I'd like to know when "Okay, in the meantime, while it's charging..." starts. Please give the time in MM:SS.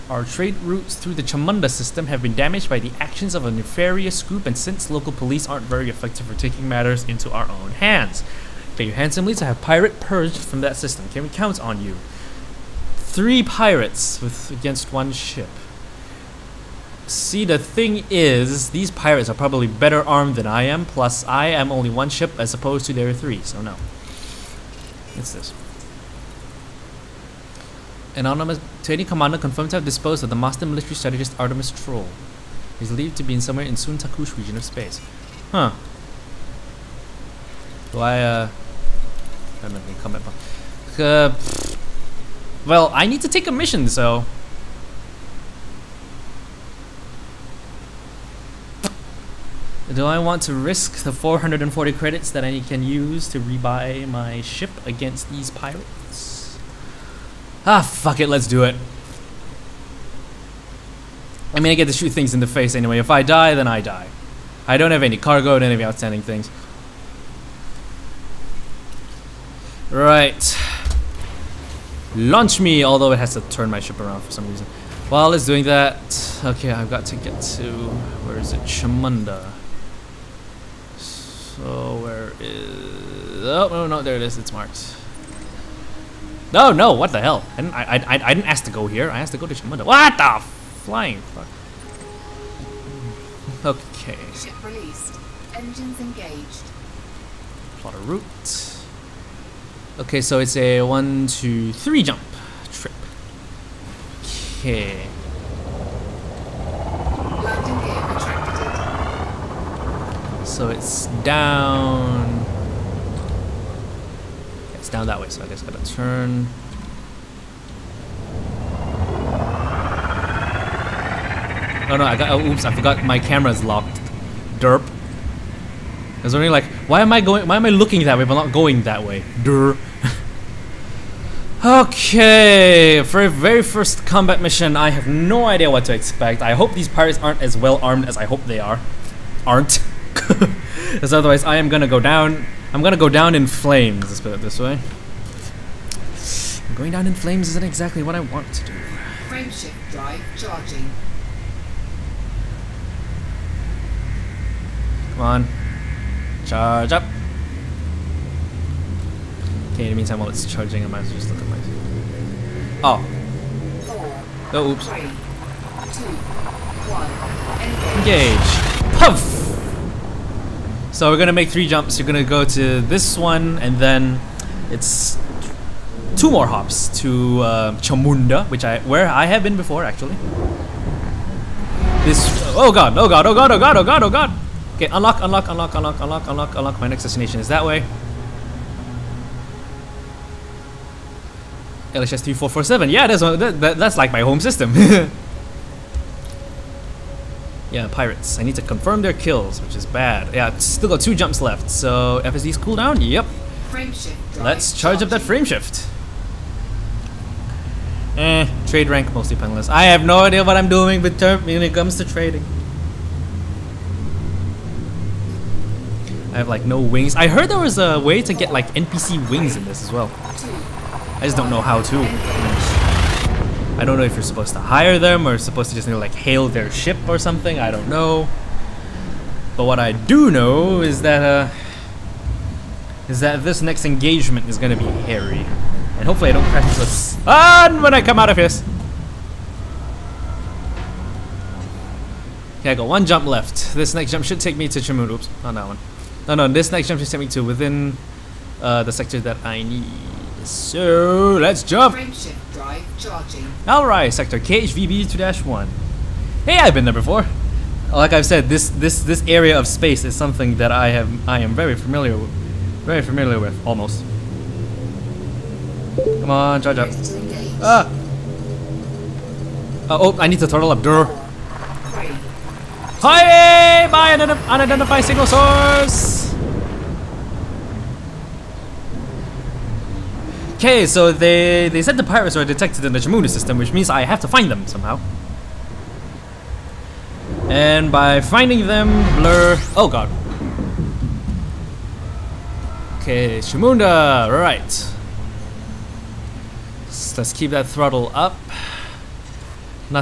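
02:39.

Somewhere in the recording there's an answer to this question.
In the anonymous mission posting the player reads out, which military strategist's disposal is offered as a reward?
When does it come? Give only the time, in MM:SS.
00:31.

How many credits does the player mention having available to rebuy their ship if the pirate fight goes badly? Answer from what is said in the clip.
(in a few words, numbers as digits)
440.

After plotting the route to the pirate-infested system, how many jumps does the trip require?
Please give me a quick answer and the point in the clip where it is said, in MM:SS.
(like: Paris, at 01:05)
3, at 01:41.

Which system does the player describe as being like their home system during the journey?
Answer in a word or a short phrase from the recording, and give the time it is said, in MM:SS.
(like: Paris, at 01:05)
LHS 3447, at 03:11.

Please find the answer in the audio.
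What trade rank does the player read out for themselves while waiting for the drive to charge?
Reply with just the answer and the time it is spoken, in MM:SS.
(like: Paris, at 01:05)
Mostly Penniless, at 03:29.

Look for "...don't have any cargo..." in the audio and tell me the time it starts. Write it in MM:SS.
01:04.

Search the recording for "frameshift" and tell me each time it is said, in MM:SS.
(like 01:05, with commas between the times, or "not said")
02:29, 03:25, 04:11.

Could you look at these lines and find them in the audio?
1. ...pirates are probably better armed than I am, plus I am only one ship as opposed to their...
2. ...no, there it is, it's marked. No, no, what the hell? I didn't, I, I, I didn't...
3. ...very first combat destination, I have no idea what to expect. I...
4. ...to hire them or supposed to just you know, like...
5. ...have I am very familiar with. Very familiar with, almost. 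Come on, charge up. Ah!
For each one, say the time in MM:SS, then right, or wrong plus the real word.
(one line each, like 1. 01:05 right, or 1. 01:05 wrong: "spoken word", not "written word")
1. 00:18 right
2. 01:23 right
3. 02:13 wrong: "mission", not "destination"
4. 03:44 right
5. 04:20 right.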